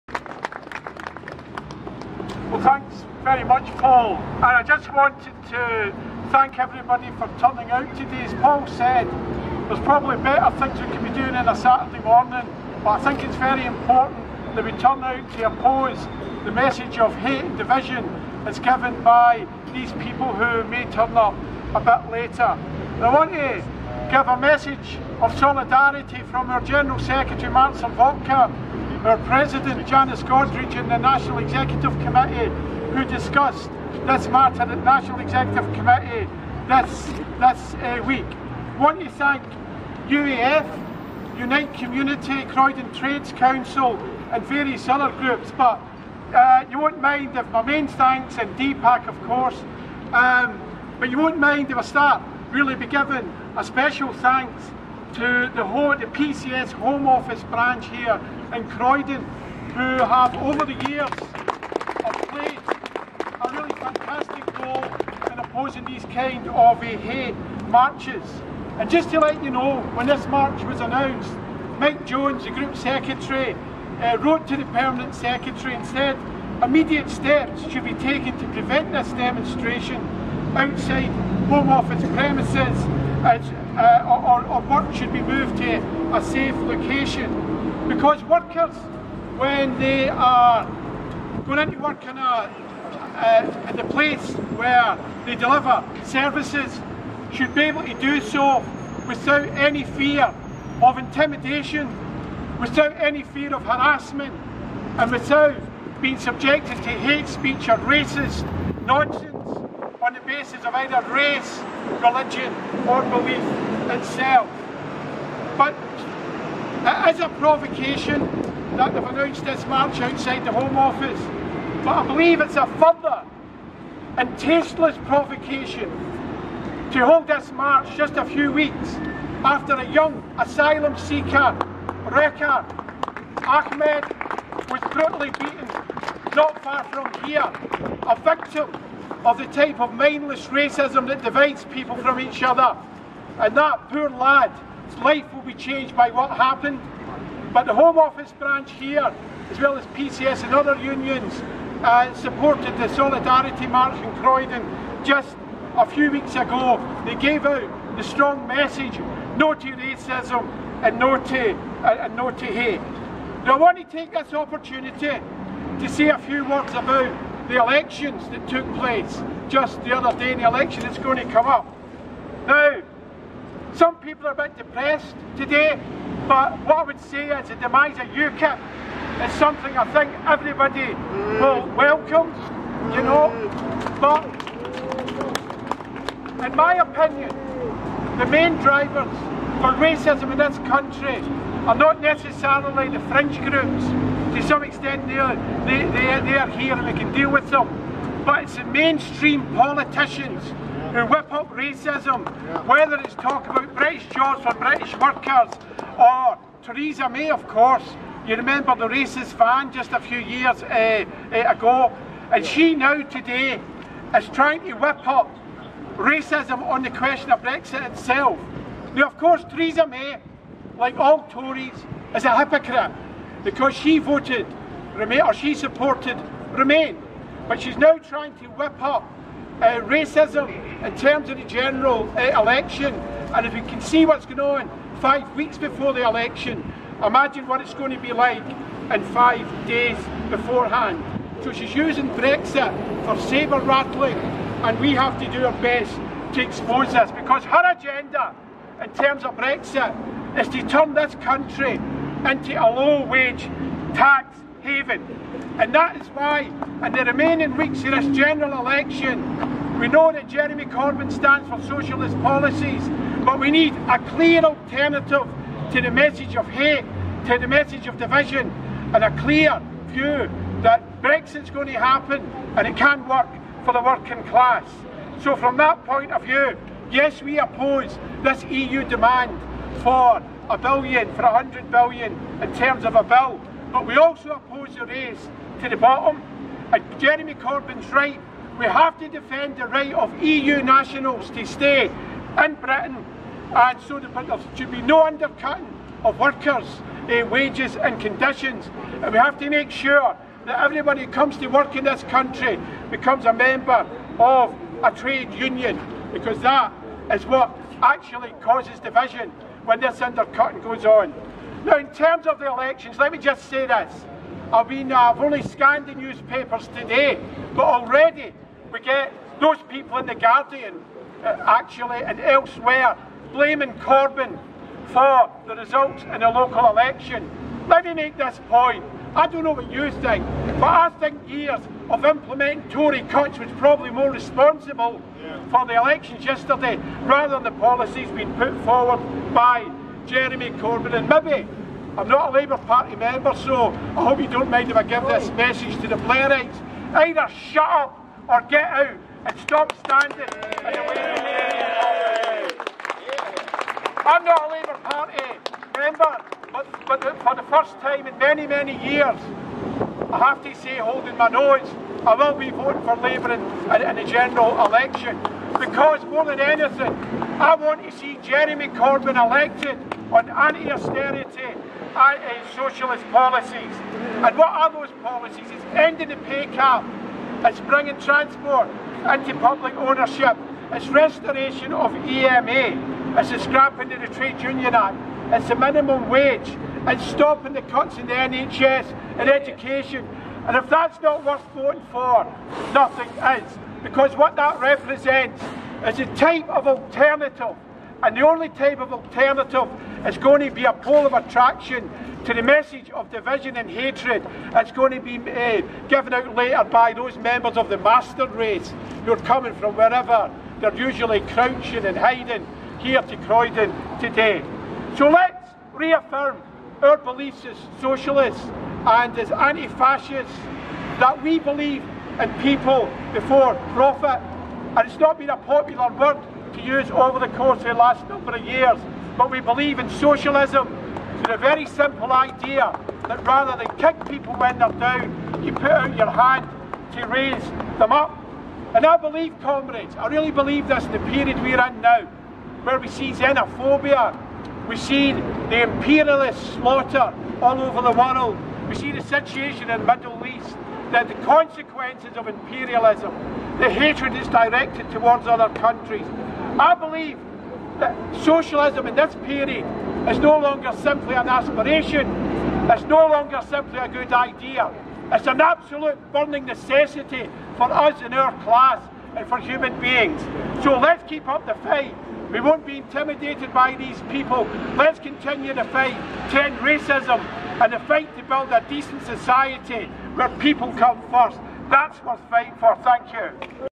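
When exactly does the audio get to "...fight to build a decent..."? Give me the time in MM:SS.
07:57.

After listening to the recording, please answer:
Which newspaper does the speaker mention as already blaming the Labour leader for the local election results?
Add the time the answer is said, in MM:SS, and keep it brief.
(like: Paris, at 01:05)
The Guardian, at 05:20.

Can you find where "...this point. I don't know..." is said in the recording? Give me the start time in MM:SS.
05:28.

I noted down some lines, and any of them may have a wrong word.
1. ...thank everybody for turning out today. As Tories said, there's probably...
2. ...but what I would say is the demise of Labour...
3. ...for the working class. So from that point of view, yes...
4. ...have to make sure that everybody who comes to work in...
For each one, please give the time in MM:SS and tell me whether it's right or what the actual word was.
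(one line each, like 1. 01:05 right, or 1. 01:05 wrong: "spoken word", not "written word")
1. 00:06 wrong: "Paul", not "Tories"
2. 02:56 wrong: "UKIP", not "Labour"
3. 04:33 right
4. 04:59 right.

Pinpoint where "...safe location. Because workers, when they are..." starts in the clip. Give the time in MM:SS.
01:26.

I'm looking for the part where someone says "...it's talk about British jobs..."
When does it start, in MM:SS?
03:22.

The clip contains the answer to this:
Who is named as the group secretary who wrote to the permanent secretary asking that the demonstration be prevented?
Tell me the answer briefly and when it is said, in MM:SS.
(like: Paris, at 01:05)
Mike Jones, at 01:11.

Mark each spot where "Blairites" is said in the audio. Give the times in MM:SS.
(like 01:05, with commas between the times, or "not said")
05:45.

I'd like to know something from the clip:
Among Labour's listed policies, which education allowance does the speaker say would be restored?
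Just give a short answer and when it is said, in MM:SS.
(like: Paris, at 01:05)
EMA, at 06:22.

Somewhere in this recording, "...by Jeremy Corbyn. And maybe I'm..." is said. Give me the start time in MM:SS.
05:39.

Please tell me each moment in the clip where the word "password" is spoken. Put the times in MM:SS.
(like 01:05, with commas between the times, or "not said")
not said.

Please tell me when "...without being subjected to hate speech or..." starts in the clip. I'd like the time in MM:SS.
01:45.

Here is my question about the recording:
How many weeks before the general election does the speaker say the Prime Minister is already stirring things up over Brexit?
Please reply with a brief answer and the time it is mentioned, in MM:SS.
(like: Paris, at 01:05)
5, at 03:54.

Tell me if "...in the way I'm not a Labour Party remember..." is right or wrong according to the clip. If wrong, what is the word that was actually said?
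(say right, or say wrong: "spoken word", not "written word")
wrong: "member", not "remember".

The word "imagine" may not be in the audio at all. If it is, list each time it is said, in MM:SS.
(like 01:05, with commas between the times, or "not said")
03:57.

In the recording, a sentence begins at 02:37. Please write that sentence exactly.
They gave out the strong message, no to racism and no to, uh, and no to hate.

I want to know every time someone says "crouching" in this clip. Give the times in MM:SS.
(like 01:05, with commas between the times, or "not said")
06:51.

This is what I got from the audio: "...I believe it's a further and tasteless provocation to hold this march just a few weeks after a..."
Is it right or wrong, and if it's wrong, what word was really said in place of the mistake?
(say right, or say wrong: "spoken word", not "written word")
right.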